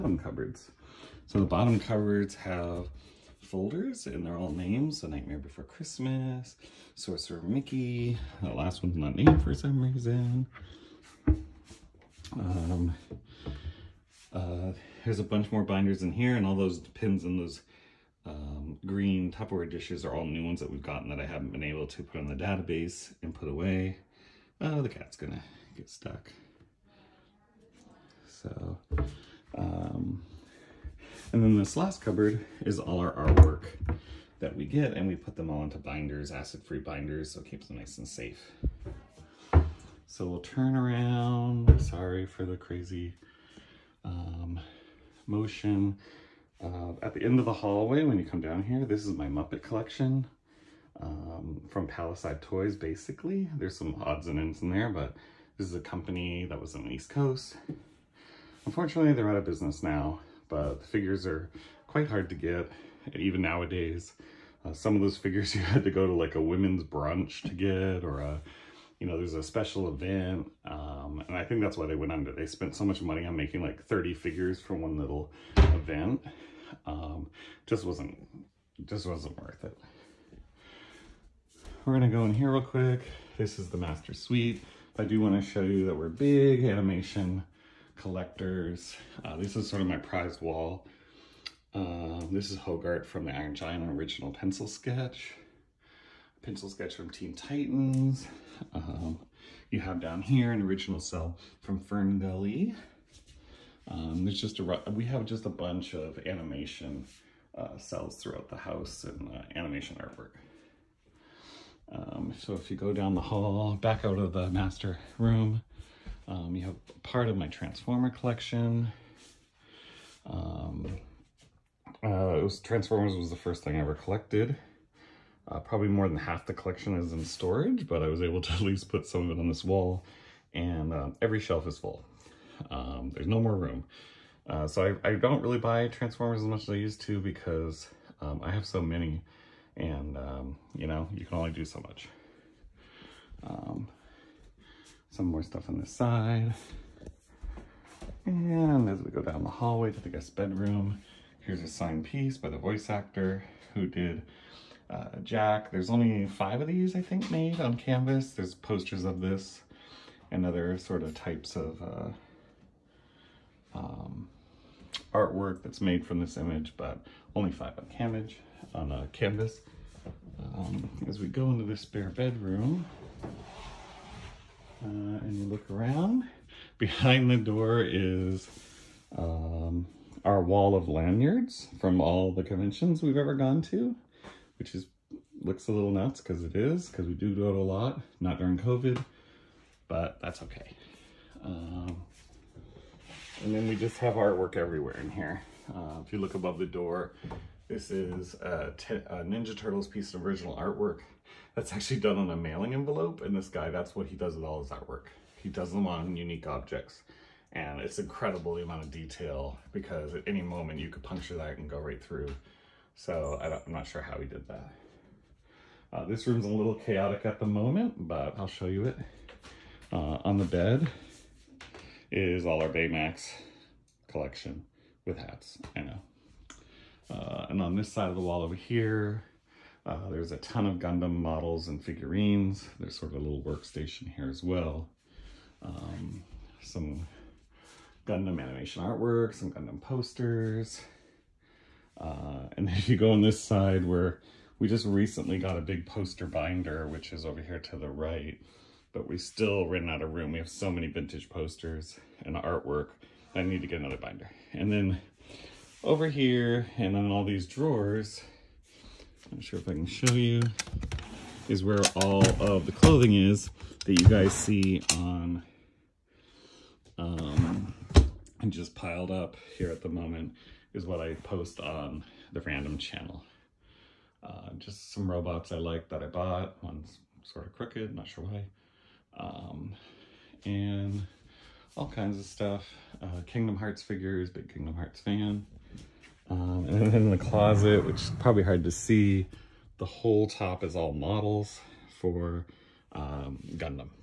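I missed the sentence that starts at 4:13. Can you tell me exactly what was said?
I need to get another binder.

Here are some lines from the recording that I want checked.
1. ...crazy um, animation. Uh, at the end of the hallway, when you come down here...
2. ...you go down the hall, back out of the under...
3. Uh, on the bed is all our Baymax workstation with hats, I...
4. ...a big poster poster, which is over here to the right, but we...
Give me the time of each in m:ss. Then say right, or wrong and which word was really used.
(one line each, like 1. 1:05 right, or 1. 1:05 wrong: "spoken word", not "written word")
1. 0:42 wrong: "motion", not "animation"
2. 1:52 wrong: "master", not "under"
3. 3:39 wrong: "collection", not "workstation"
4. 4:05 wrong: "binder", not "poster".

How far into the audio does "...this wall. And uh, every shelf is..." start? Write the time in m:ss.
2:09.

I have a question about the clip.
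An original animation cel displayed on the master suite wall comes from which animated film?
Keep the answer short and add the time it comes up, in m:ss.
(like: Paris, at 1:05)
FernGully, at 1:41.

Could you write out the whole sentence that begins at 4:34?
Uh, just some robots I like that I bought.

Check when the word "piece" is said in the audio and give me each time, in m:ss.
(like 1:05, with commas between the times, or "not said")
2:32, 3:19.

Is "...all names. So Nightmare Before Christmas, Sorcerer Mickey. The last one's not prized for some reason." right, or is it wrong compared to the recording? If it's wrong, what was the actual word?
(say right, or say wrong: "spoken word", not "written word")
wrong: "named", not "prized".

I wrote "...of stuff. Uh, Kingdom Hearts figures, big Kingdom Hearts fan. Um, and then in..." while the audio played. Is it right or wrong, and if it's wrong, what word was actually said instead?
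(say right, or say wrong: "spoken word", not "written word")
right.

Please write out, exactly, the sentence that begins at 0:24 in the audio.
Oh, the cat's gonna get stuck.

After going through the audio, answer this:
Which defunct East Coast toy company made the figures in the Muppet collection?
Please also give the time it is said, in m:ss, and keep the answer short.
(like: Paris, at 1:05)
Palisade Toys, at 0:51.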